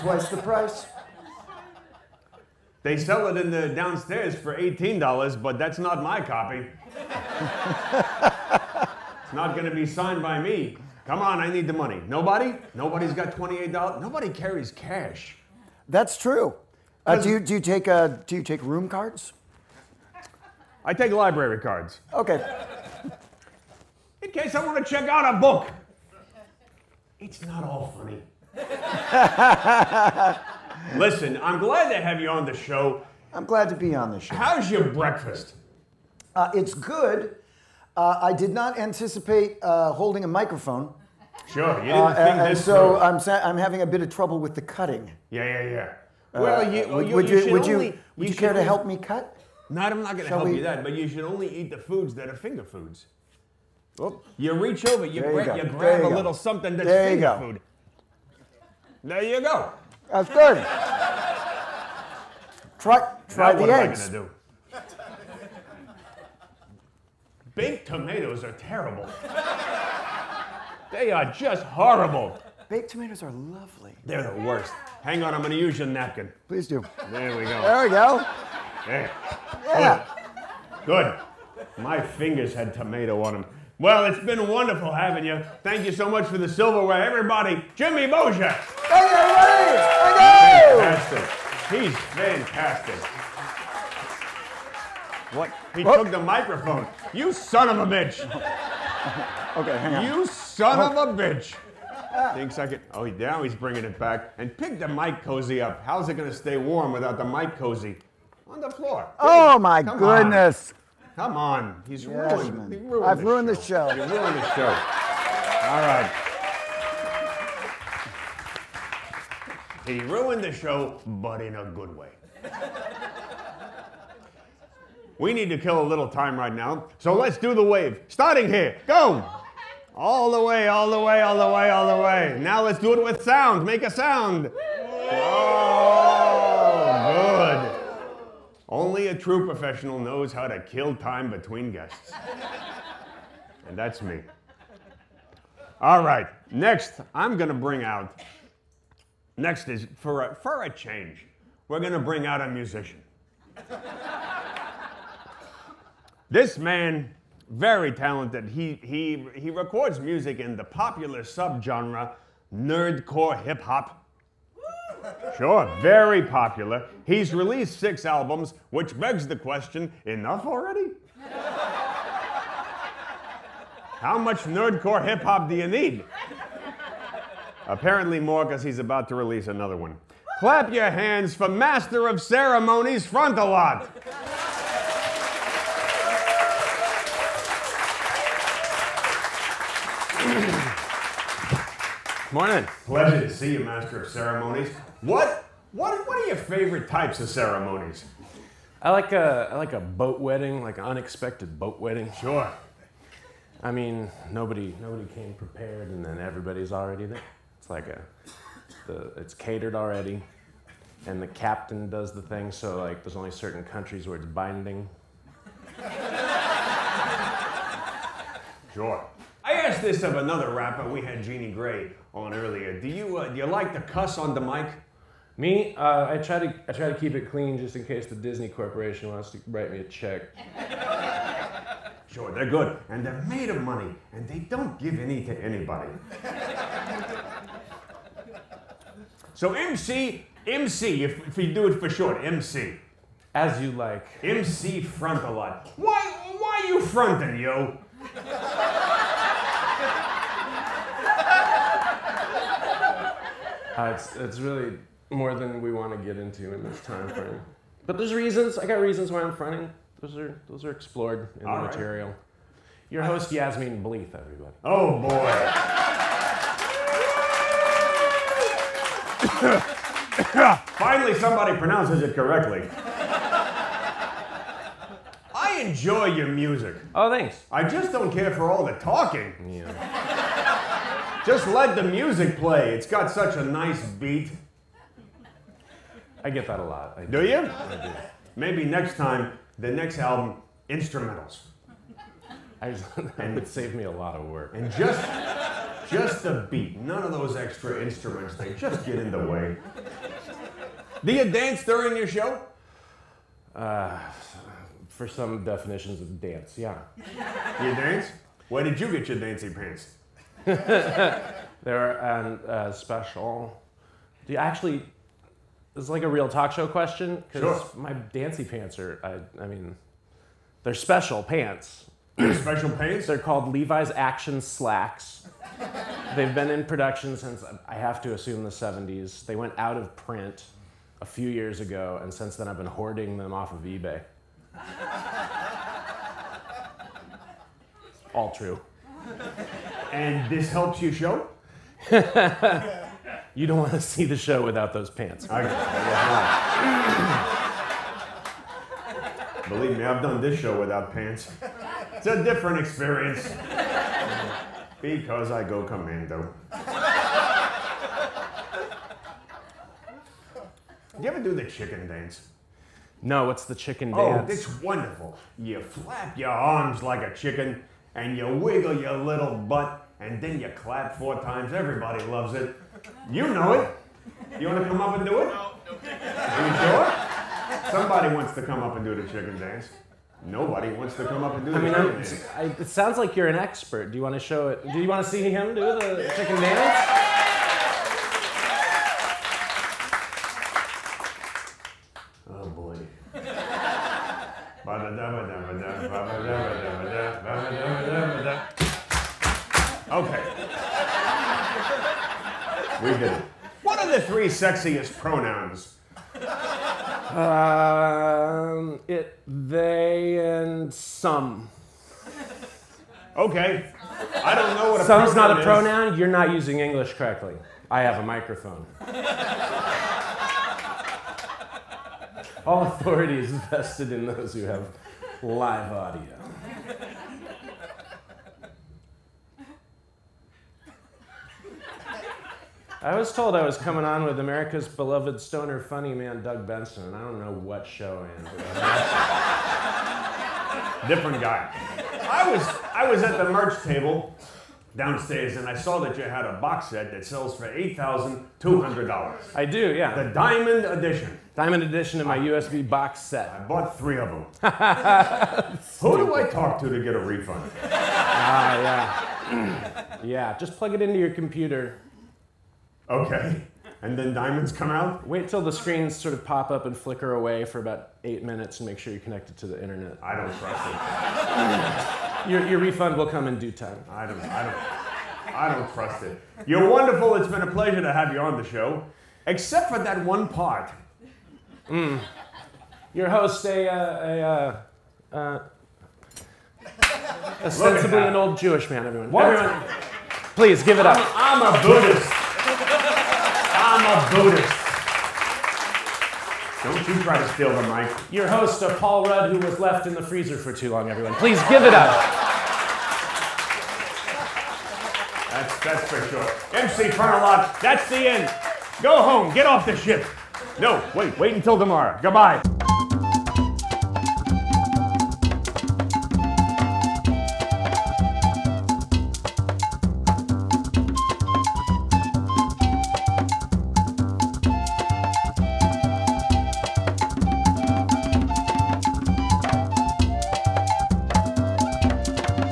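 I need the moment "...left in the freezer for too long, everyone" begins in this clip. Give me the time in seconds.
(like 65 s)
499 s.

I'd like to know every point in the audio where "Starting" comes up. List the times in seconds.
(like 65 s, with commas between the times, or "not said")
128 s.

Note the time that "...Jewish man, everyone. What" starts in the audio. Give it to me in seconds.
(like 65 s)
488 s.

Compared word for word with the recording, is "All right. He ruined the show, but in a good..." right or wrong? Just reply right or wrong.
right.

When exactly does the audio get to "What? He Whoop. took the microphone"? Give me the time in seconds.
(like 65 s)
95 s.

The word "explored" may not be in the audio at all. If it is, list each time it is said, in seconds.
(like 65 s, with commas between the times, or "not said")
260 s.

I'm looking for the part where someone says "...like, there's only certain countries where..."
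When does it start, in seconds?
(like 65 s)
212 s.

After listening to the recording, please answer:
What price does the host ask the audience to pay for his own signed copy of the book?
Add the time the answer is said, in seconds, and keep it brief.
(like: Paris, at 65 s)
$28, at 13 s.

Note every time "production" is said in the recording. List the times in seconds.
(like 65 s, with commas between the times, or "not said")
326 s.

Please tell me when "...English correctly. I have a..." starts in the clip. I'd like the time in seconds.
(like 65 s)
416 s.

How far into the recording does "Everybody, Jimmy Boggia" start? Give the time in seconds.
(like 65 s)
87 s.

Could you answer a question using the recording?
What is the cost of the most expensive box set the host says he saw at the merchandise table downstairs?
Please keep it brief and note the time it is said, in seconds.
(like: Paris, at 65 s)
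$8,200, at 447 s.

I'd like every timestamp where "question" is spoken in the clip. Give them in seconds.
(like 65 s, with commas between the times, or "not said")
169 s, 316 s.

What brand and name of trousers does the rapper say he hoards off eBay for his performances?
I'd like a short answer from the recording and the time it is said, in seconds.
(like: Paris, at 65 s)
Levi's Action Slacks, at 323 s.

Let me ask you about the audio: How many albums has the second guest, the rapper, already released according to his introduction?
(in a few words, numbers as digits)
6.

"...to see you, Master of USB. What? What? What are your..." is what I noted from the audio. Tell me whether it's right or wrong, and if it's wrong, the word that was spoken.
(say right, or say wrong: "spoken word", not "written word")
wrong: "Ceremonies", not "USB".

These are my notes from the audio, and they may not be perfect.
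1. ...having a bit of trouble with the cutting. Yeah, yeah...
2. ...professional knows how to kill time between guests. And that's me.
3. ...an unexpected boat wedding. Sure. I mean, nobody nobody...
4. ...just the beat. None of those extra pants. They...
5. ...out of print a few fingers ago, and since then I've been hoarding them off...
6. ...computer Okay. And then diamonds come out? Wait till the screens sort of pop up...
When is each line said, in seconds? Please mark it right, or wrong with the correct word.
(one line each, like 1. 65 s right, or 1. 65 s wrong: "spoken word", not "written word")
1. 43 s right
2. 139 s right
3. 200 s right
4. 295 s wrong: "instruments", not "pants"
5. 329 s wrong: "years", not "fingers"
6. 461 s right.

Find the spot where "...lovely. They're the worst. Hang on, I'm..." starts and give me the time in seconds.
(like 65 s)
73 s.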